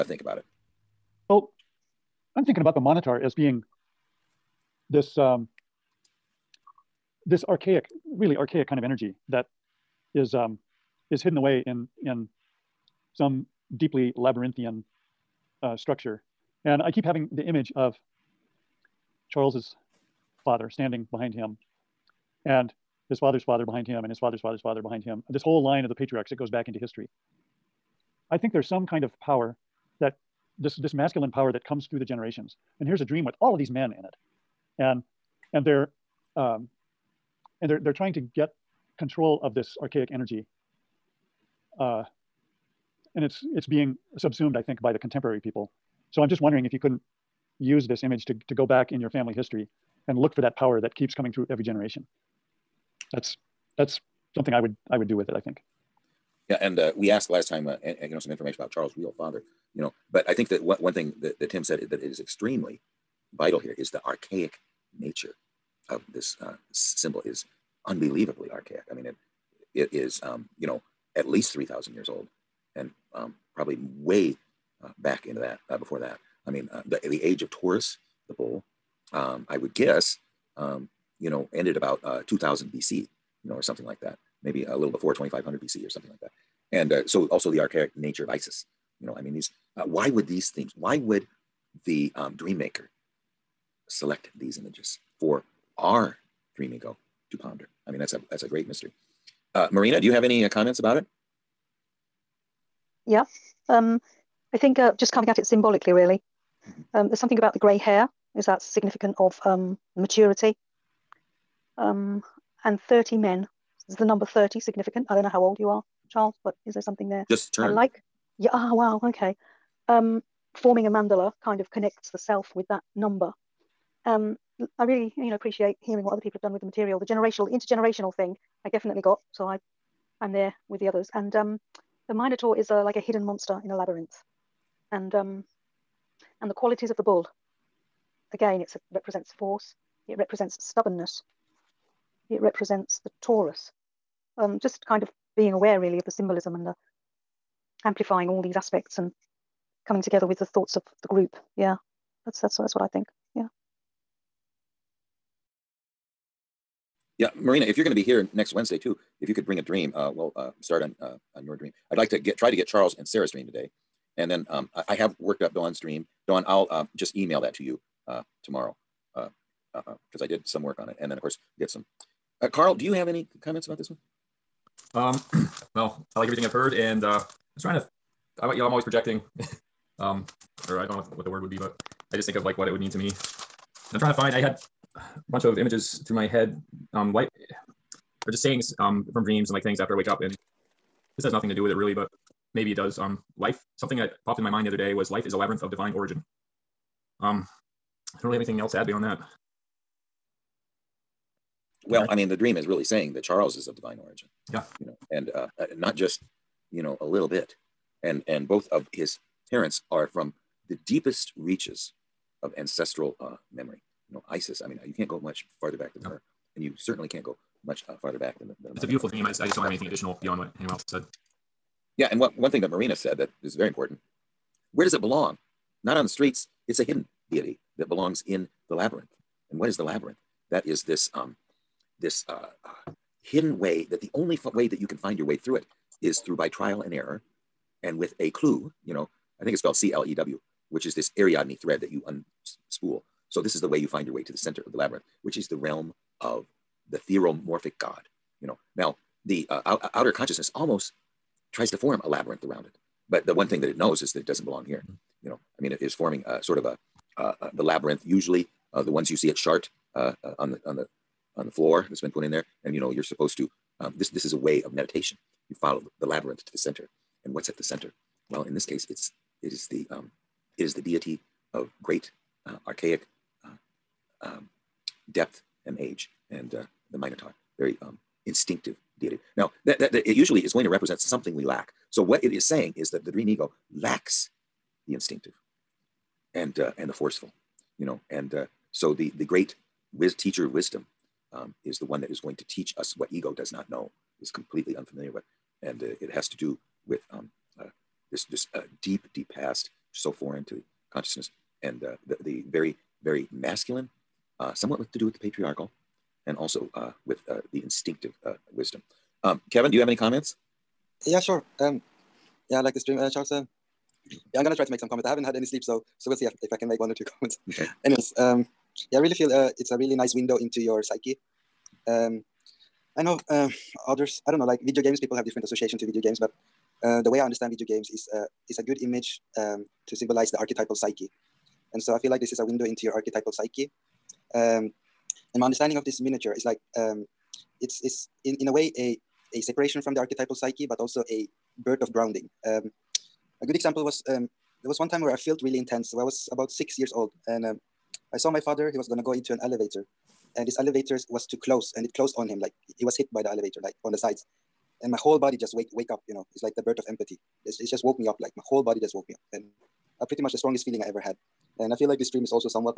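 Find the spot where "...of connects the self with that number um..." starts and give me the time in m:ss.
2:01.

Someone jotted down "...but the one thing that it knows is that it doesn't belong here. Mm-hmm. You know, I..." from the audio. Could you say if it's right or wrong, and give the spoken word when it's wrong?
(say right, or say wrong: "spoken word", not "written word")
right.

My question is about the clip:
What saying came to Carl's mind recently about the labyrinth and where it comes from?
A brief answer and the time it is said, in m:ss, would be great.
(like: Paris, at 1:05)
Life is a labyrinth of divine origin, at 3:15.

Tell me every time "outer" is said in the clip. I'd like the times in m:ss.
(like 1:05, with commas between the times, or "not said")
4:09.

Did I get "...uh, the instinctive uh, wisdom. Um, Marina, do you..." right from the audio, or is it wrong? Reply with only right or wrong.
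wrong.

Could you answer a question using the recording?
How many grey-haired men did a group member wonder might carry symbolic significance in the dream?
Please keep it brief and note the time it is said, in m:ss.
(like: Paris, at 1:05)
30, at 1:52.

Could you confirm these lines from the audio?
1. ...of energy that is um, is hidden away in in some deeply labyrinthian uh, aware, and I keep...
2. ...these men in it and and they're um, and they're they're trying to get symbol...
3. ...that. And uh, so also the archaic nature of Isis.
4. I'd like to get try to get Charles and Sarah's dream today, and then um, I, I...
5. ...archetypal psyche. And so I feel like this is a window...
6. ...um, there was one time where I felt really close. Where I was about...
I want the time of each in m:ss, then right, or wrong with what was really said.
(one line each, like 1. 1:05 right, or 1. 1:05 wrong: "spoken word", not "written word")
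1. 0:08 wrong: "structure", not "aware"
2. 0:33 wrong: "control", not "symbol"
3. 1:26 right
4. 2:41 right
5. 5:30 right
6. 5:44 wrong: "intense", not "close".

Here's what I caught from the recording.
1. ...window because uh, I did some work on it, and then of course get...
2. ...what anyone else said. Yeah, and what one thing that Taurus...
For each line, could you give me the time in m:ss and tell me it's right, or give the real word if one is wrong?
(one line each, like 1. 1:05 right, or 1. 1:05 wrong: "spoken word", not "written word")
1. 2:48 wrong: "tomorrow", not "window"
2. 3:40 wrong: "Marina", not "Taurus".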